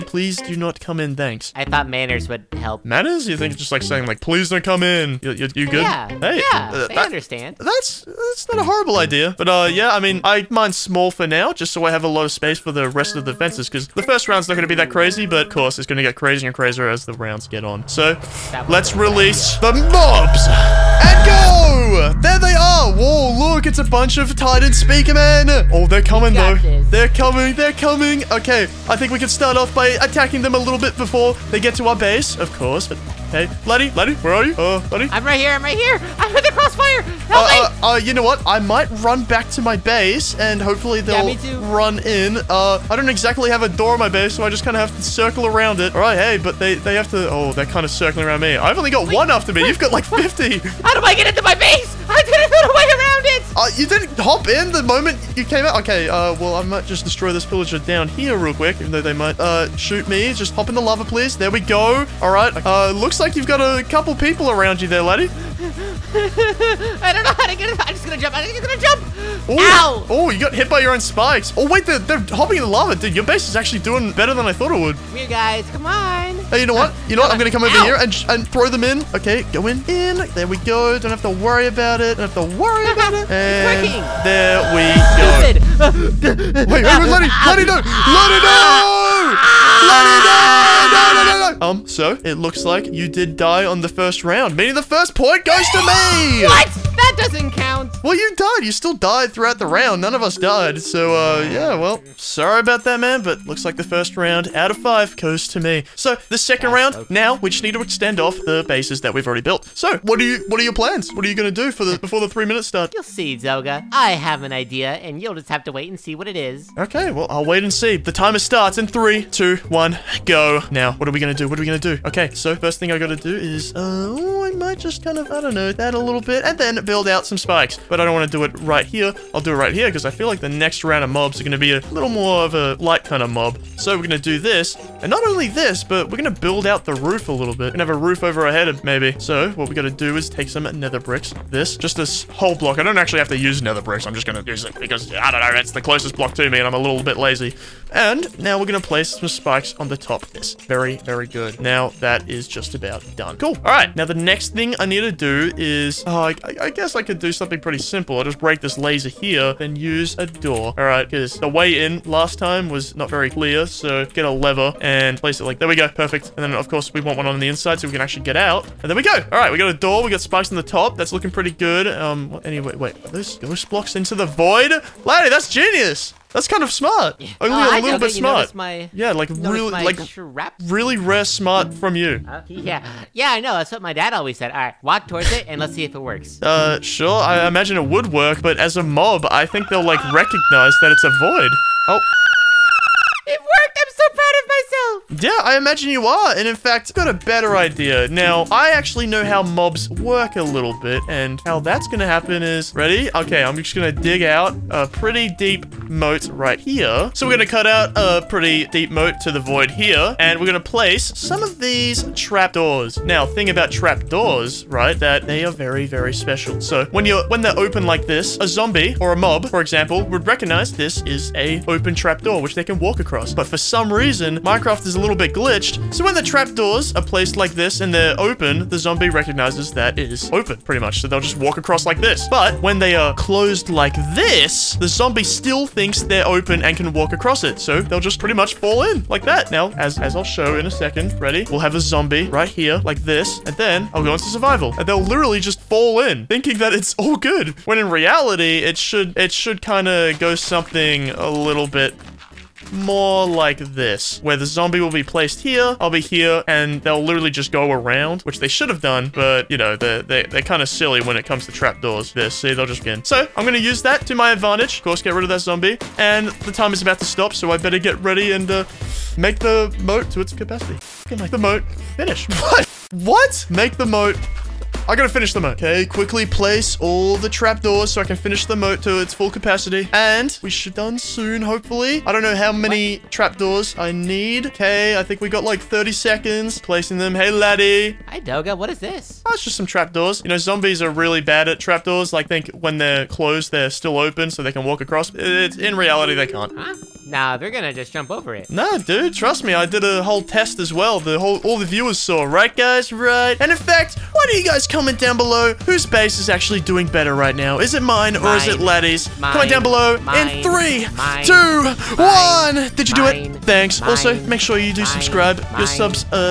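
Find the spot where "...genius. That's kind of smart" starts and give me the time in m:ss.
2:55.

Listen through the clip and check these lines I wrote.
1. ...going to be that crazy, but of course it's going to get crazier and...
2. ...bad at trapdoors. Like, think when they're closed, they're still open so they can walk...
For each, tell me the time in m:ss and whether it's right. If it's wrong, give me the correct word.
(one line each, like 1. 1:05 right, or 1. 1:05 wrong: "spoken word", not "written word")
1. 0:14 right
2. 4:51 right.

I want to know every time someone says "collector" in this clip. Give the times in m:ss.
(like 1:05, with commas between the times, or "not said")
not said.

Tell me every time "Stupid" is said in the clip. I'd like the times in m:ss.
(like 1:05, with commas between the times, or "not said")
1:25.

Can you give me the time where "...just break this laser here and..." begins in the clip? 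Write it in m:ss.
2:38.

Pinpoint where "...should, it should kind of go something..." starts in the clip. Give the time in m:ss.
4:08.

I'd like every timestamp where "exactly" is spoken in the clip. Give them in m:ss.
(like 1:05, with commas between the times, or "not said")
0:43.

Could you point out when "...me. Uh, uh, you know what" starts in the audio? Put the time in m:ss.
0:37.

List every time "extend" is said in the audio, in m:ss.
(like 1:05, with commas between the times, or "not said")
1:47.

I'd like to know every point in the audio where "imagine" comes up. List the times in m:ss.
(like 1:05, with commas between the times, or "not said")
3:07, 3:15.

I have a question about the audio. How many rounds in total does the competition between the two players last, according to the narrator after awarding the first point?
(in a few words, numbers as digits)
5.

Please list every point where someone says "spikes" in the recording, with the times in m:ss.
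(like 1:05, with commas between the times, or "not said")
1:11, 2:07, 2:29, 2:50.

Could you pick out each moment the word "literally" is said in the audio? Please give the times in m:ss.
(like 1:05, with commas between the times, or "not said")
4:04, 4:17.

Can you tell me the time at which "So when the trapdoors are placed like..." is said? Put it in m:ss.
3:45.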